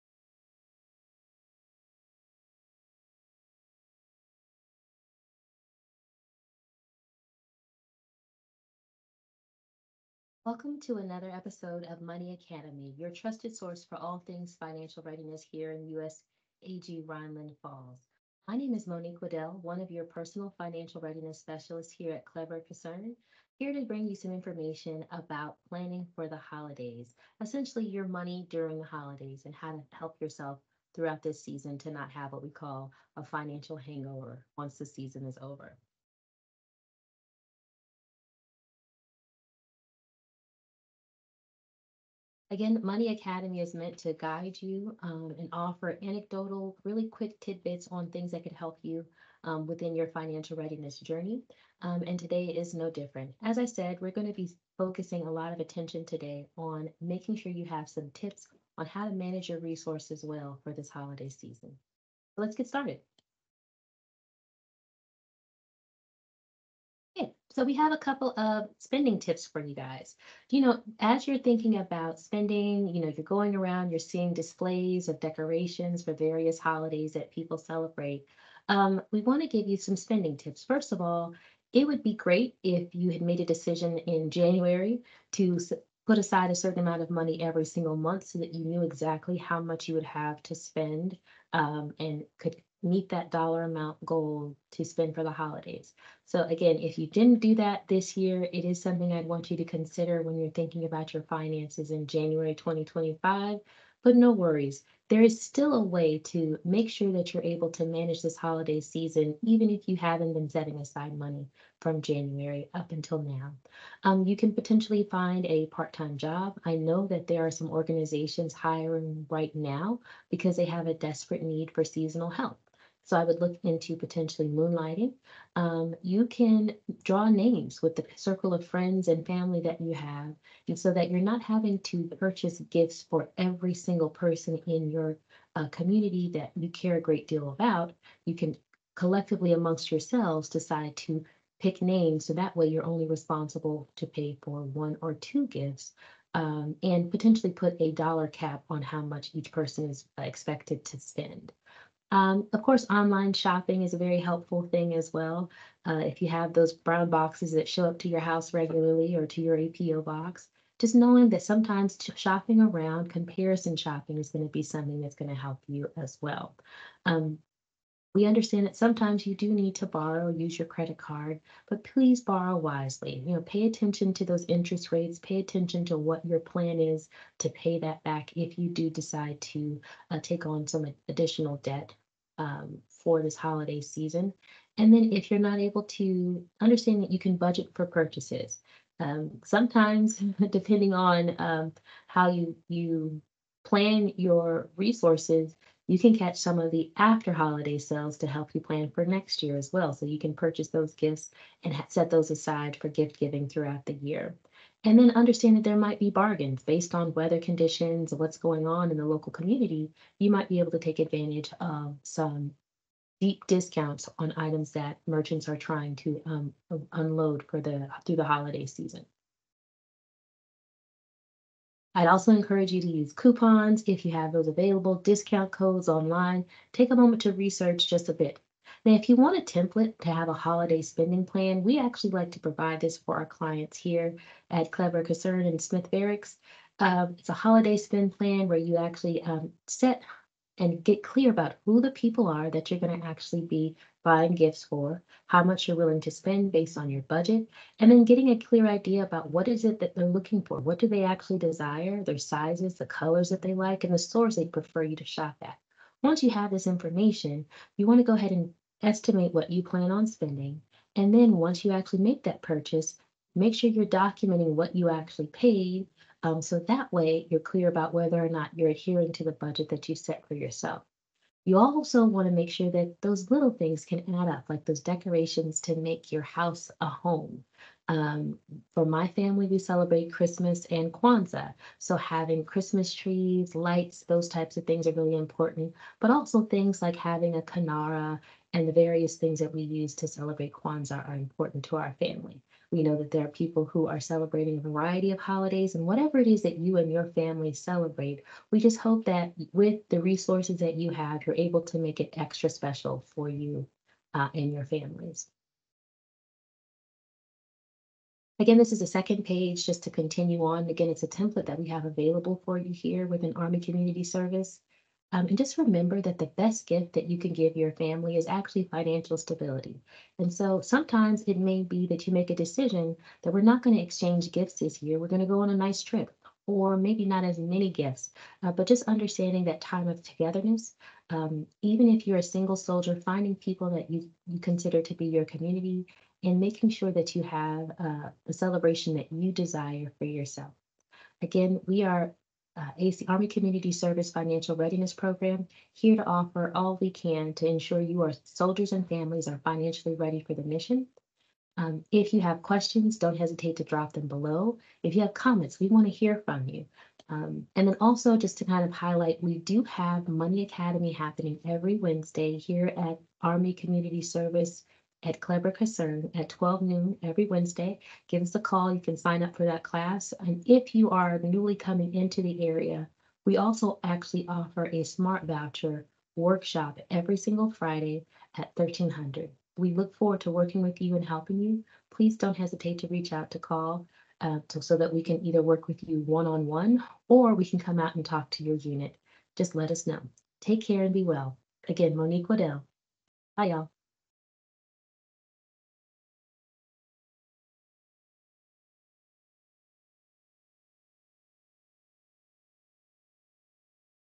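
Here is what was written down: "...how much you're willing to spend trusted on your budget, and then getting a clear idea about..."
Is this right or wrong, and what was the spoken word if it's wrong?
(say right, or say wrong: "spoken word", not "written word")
wrong: "based", not "trusted".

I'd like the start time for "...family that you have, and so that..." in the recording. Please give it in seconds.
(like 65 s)
129 s.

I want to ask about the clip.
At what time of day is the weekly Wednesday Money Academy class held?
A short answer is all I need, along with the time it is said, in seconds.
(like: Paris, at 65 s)
12 noon, at 366 s.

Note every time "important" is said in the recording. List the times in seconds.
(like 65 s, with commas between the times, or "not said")
285 s, 291 s.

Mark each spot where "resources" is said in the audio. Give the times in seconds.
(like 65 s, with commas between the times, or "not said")
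59 s, 194 s, 300 s.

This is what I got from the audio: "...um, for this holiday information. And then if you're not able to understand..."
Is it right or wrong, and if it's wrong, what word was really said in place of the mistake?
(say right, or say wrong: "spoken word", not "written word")
wrong: "season", not "information".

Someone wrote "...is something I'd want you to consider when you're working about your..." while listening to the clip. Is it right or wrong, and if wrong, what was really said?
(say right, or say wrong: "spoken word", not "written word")
wrong: "thinking", not "working".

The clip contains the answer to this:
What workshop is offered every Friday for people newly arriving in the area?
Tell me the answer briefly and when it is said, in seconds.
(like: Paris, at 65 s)
smart voucher workshop, at 374 s.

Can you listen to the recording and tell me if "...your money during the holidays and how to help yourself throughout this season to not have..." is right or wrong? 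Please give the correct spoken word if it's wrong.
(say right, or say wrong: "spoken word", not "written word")
right.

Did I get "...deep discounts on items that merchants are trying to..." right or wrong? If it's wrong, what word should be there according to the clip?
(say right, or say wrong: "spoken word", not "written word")
right.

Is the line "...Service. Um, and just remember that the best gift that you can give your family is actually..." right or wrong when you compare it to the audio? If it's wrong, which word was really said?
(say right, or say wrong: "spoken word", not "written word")
right.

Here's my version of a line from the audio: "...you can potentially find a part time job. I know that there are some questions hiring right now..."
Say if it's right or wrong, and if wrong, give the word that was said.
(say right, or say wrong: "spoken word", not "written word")
wrong: "organizations", not "questions".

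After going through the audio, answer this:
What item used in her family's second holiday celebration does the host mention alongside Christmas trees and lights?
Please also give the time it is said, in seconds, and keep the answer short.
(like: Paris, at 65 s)
kinara, at 287 s.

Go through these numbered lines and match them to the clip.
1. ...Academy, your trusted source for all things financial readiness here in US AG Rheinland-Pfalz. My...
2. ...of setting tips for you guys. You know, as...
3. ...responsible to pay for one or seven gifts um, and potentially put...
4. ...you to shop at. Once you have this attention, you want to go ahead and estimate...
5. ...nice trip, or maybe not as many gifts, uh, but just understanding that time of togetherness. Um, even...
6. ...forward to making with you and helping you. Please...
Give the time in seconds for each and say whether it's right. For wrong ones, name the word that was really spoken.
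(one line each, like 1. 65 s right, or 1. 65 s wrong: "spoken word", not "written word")
1. 12 s right
2. 68 s wrong: "spending", not "setting"
3. 143 s wrong: "two", not "seven"
4. 254 s wrong: "information", not "attention"
5. 325 s right
6. 379 s wrong: "working", not "making".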